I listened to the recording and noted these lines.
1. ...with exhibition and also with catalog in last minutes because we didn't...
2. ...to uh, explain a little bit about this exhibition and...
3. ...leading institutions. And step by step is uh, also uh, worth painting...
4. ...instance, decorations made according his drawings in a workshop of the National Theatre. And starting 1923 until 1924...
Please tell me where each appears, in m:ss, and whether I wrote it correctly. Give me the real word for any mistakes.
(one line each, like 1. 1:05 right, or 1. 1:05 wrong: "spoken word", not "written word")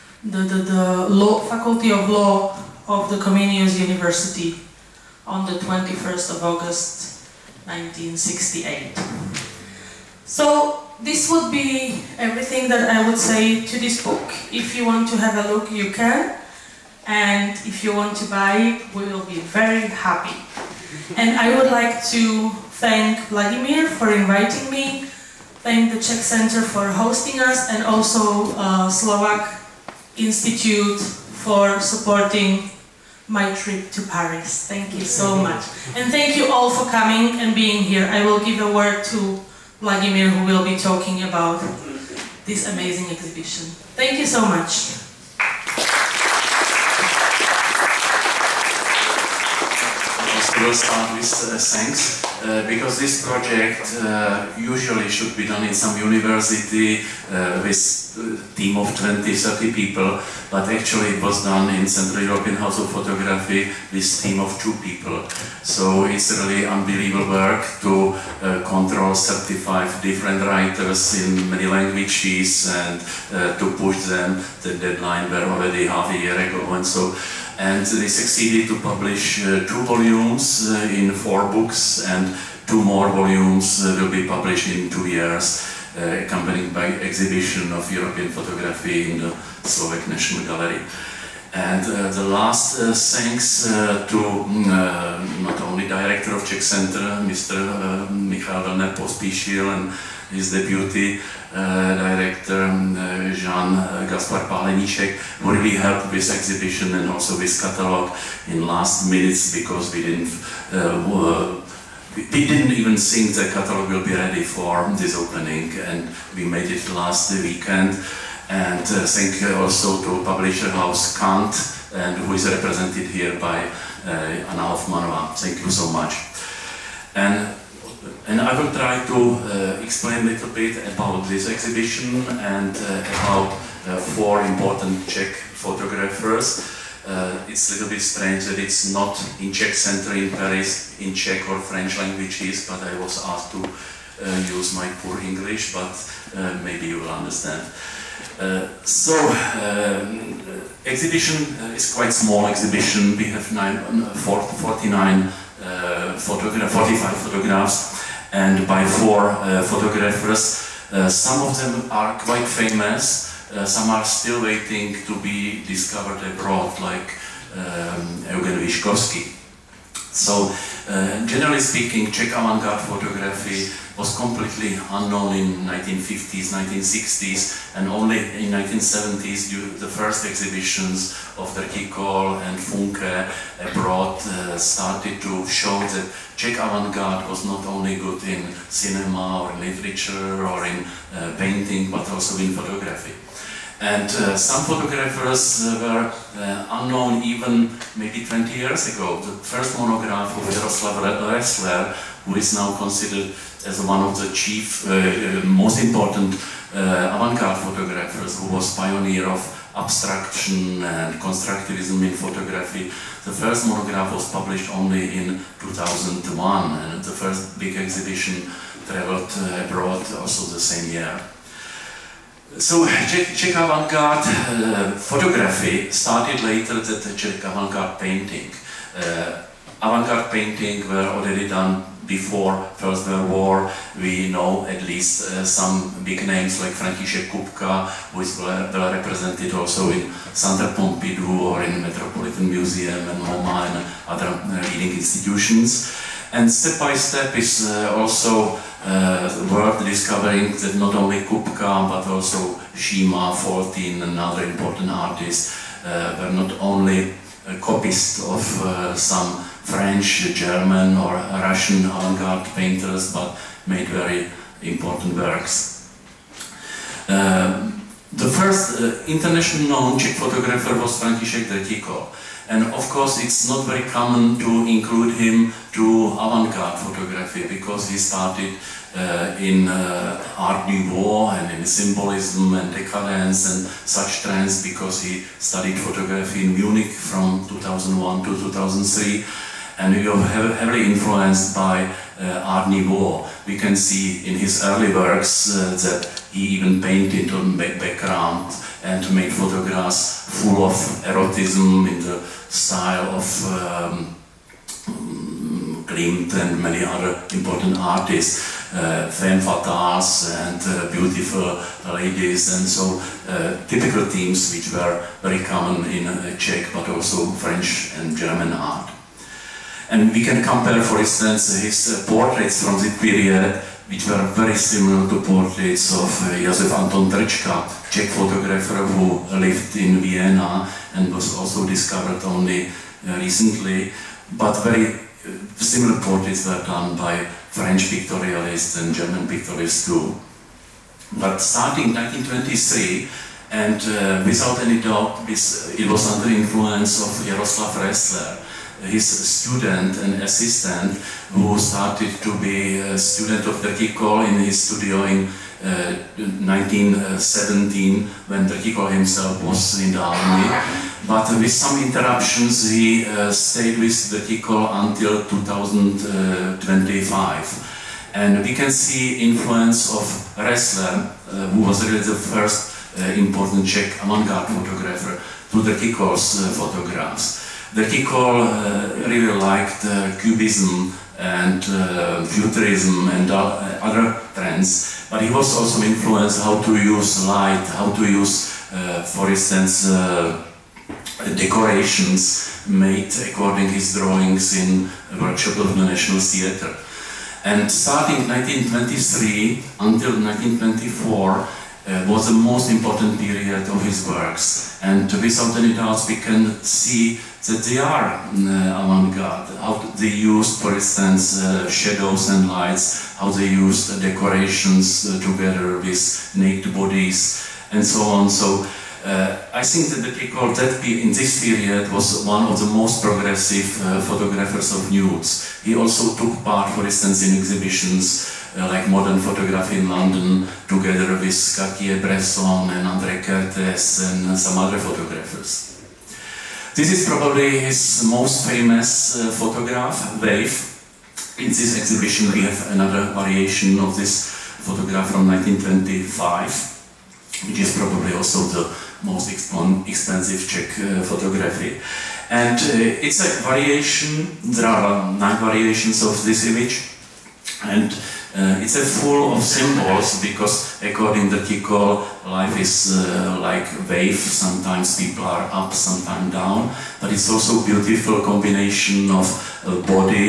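1. 1:46 right
2. 2:09 right
3. 4:04 wrong: "discovering", not "painting"
4. 6:29 right.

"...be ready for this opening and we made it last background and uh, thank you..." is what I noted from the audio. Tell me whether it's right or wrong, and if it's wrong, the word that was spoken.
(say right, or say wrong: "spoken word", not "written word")
wrong: "weekend", not "background".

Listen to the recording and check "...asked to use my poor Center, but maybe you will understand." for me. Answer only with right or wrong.
wrong.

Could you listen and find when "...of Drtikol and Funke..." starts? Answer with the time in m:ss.
3:01.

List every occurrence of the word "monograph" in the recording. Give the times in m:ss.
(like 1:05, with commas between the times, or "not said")
3:19, 3:33.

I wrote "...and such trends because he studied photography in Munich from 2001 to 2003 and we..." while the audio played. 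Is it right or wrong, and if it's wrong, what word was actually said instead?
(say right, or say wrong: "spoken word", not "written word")
right.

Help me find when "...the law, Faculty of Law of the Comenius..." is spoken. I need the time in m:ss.
0:00.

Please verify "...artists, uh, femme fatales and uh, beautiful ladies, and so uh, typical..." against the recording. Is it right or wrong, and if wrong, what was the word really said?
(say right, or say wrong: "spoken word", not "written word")
right.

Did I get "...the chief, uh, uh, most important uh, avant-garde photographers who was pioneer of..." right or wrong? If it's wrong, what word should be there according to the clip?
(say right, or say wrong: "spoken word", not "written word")
right.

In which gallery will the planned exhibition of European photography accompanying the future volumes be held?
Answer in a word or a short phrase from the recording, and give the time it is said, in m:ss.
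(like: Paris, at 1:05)
Slovak National Gallery, at 1:29.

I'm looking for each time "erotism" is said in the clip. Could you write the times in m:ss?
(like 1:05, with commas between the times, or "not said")
5:01.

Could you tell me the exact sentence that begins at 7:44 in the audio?
Sometimes people are up, sometimes down.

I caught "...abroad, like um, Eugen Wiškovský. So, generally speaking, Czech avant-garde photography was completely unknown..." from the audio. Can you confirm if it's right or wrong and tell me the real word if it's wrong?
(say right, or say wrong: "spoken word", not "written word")
right.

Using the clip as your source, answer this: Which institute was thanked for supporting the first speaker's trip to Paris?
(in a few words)
Slovak Institute.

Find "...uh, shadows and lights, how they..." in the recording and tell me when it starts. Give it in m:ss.
6:51.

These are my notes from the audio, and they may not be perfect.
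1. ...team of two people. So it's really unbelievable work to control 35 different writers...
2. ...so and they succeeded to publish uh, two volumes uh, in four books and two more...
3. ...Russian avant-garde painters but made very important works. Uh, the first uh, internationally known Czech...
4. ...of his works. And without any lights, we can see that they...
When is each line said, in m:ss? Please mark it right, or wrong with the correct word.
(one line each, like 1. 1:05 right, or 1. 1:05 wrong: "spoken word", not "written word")
1. 1:04 right
2. 1:16 right
3. 4:21 right
4. 6:43 wrong: "doubts", not "lights".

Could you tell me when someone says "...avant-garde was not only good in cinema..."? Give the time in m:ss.
3:06.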